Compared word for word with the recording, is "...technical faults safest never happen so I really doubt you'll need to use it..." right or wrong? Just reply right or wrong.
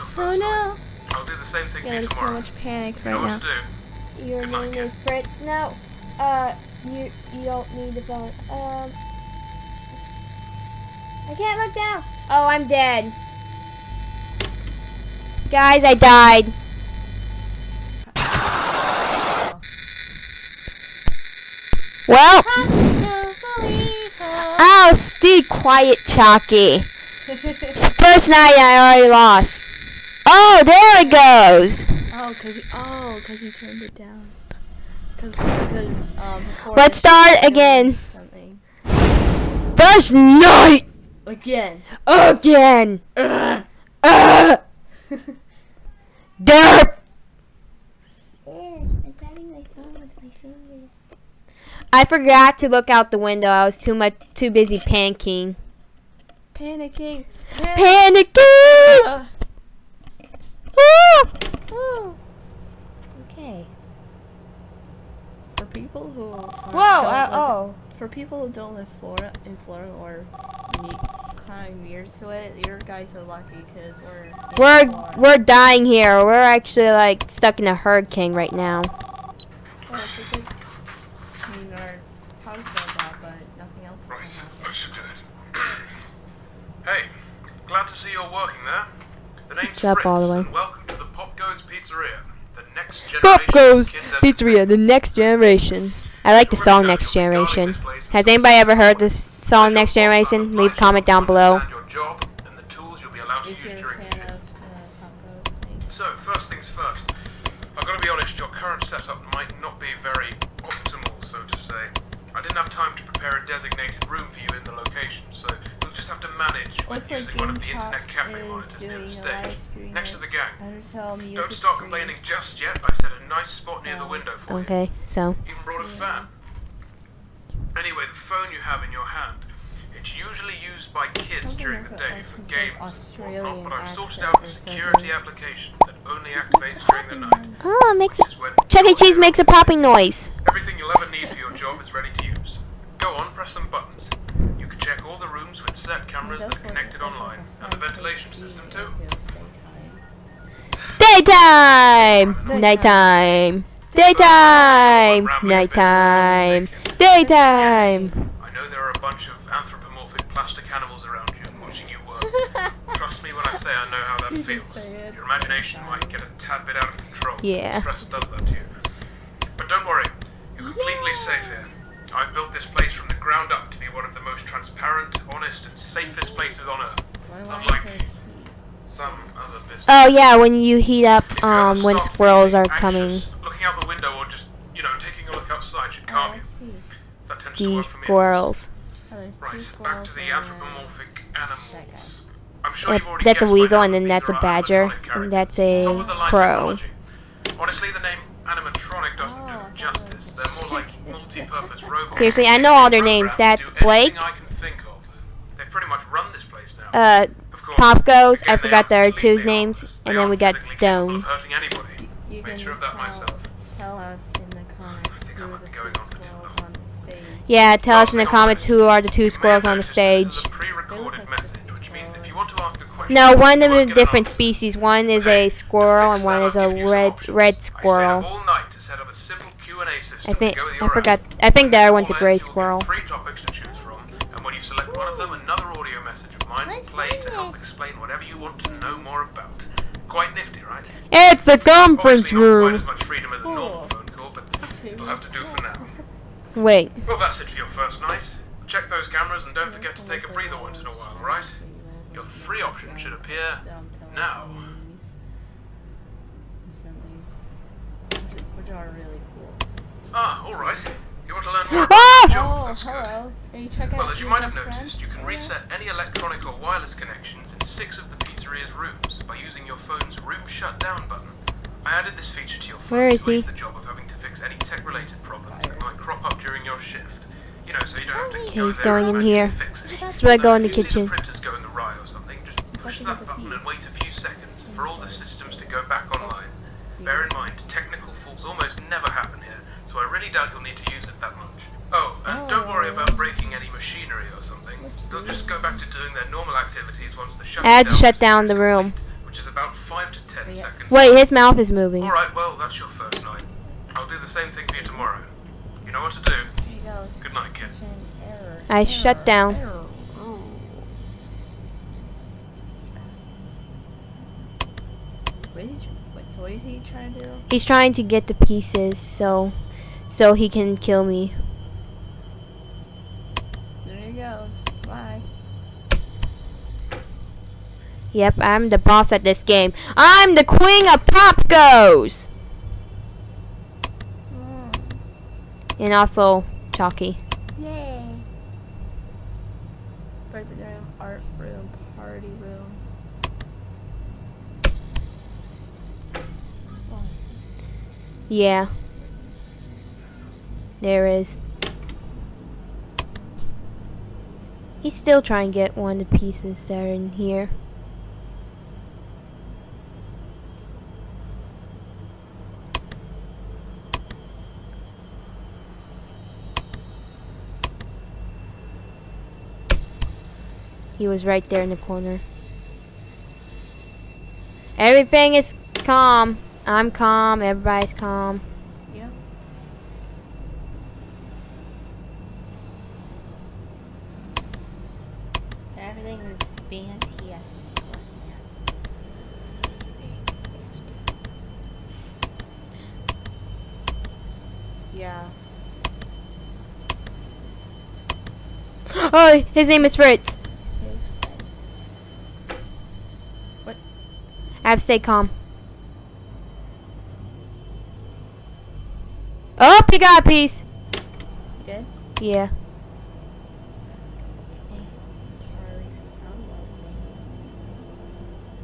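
wrong.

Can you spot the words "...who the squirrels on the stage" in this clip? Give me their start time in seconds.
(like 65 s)
215 s.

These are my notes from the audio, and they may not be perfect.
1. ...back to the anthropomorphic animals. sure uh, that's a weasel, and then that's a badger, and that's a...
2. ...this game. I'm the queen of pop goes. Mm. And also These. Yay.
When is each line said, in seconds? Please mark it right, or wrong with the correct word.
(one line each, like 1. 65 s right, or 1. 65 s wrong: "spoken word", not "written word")
1. 189 s right
2. 329 s wrong: "Chalky", not "These".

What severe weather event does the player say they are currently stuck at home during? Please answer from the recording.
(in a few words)
hurricane.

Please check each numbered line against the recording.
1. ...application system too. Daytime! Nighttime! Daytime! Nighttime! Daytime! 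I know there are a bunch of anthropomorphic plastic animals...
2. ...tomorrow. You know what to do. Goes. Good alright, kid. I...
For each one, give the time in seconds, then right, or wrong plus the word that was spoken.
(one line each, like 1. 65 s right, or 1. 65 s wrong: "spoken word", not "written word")
1. 147 s wrong: "ventilation", not "application"
2. 304 s wrong: "night", not "alright".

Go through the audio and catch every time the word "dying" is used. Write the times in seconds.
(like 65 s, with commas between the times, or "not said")
75 s.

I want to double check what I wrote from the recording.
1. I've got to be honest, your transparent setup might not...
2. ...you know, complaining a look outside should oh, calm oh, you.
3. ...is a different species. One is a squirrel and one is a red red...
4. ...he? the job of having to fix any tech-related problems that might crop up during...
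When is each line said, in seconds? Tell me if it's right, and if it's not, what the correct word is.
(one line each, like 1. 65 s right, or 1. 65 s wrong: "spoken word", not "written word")
1. 107 s wrong: "current", not "transparent"
2. 184 s wrong: "taking", not "complaining"
3. 223 s right
4. 273 s right.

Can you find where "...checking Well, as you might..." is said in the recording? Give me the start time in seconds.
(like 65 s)
263 s.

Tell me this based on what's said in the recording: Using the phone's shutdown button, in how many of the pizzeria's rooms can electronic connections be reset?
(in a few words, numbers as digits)
6.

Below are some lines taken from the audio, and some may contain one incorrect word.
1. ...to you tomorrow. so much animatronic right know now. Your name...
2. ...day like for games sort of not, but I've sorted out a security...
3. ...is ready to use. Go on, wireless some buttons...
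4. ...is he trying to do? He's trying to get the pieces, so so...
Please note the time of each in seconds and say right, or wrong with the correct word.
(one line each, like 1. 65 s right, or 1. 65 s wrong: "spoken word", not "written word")
1. 1 s wrong: "panic", not "animatronic"
2. 131 s right
3. 141 s wrong: "press", not "wireless"
4. 316 s right.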